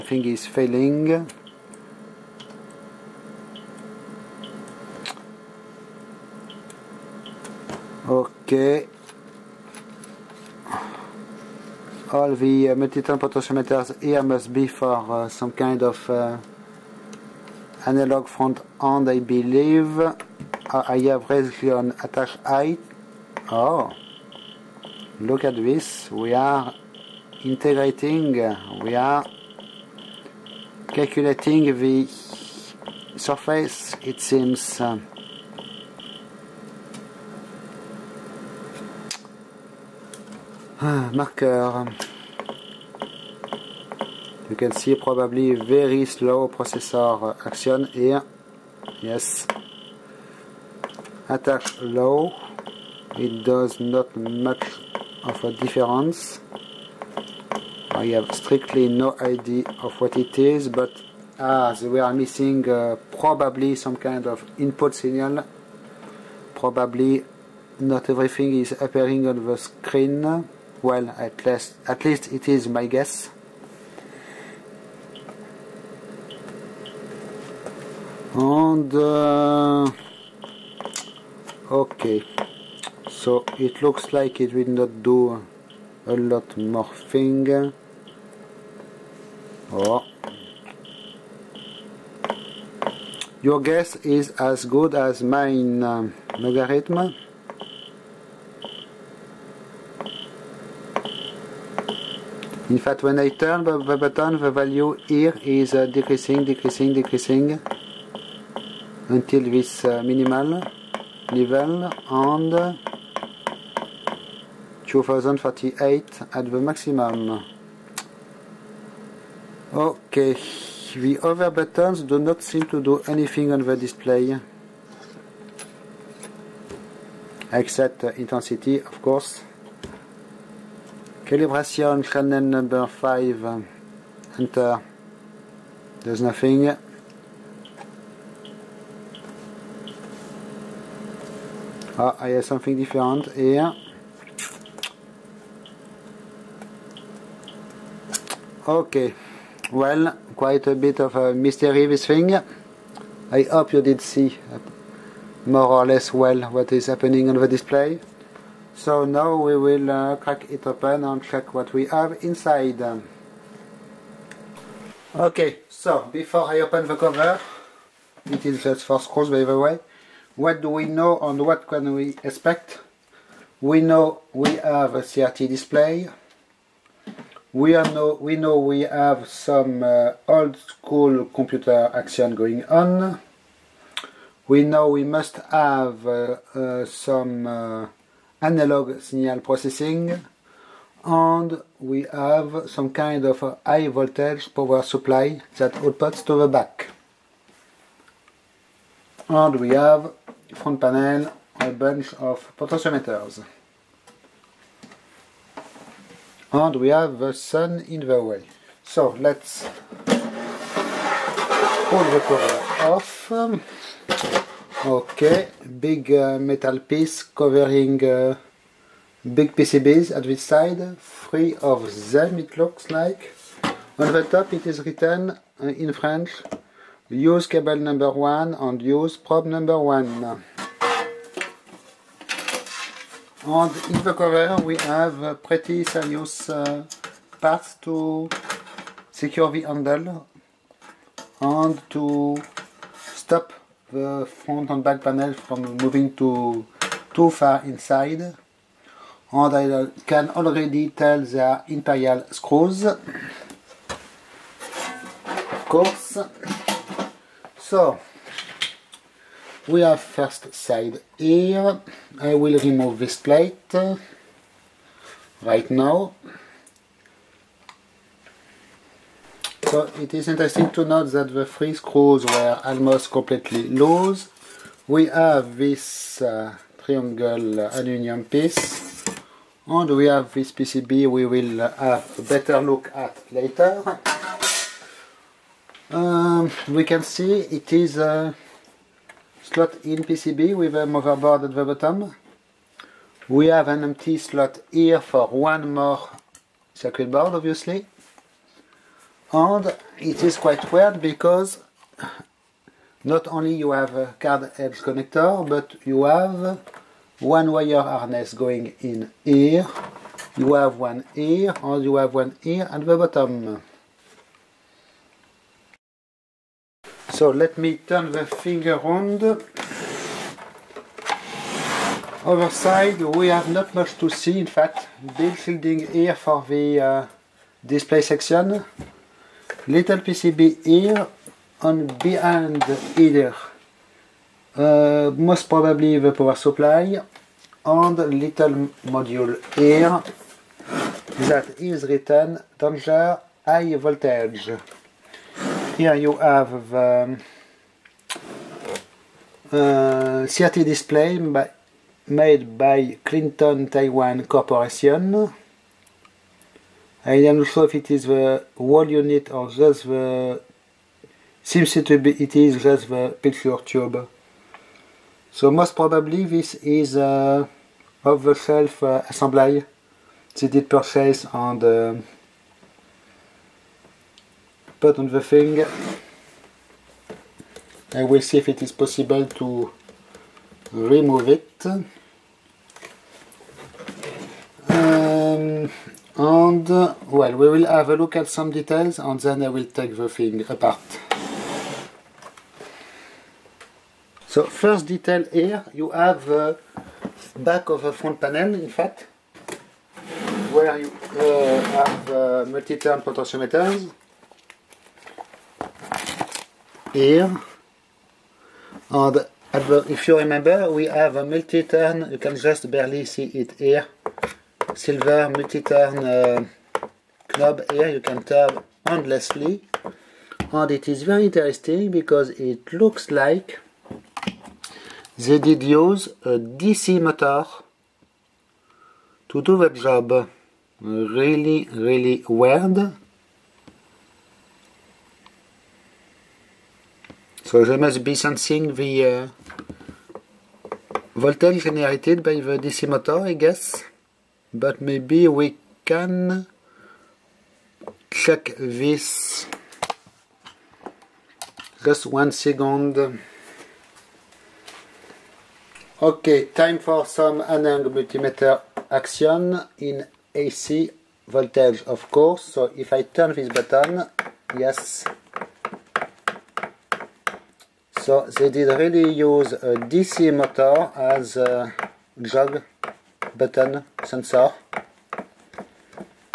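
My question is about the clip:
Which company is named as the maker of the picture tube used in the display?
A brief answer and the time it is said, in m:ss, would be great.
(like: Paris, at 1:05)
Clinton Taiwan Corporation, at 5:53.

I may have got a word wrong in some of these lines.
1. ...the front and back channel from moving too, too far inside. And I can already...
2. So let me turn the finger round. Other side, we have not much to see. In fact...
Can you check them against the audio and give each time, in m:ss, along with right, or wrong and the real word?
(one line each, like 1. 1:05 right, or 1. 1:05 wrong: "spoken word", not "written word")
1. 4:03 wrong: "panel", not "channel"
2. 5:17 right.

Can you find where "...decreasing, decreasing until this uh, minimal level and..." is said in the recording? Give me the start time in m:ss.
1:46.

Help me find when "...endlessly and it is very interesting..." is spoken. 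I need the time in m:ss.
6:58.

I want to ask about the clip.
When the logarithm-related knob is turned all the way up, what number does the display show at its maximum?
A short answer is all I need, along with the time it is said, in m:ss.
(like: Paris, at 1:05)
2038, at 1:54.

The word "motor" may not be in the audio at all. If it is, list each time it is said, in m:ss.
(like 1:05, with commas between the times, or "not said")
7:06, 7:22, 7:50.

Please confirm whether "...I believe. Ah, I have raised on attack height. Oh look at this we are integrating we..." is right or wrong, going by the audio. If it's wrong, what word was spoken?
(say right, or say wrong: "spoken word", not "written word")
right.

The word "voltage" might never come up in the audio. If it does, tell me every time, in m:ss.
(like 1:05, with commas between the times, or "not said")
3:13, 5:43, 7:21, 7:41.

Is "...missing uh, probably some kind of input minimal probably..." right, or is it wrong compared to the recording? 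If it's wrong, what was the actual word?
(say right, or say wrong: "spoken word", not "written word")
wrong: "signal", not "minimal".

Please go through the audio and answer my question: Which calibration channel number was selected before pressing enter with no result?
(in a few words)
5.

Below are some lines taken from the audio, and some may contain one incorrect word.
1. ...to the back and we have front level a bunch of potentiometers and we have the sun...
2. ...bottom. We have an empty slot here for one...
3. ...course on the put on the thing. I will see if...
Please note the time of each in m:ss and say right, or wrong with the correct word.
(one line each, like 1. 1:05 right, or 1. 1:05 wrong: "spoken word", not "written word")
1. 3:16 wrong: "panel", not "level"
2. 4:51 right
3. 6:10 wrong: "purchase", not "course".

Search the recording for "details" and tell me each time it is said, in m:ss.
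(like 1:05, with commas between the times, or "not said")
6:28, 6:34.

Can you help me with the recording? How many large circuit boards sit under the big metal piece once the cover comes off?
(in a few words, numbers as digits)
3.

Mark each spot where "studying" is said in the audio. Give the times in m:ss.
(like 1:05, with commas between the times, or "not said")
not said.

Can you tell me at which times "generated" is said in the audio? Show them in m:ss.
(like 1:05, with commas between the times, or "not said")
7:21.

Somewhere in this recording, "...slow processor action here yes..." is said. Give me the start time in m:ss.
0:46.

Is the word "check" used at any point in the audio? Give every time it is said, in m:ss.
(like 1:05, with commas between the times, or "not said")
2:41, 7:28.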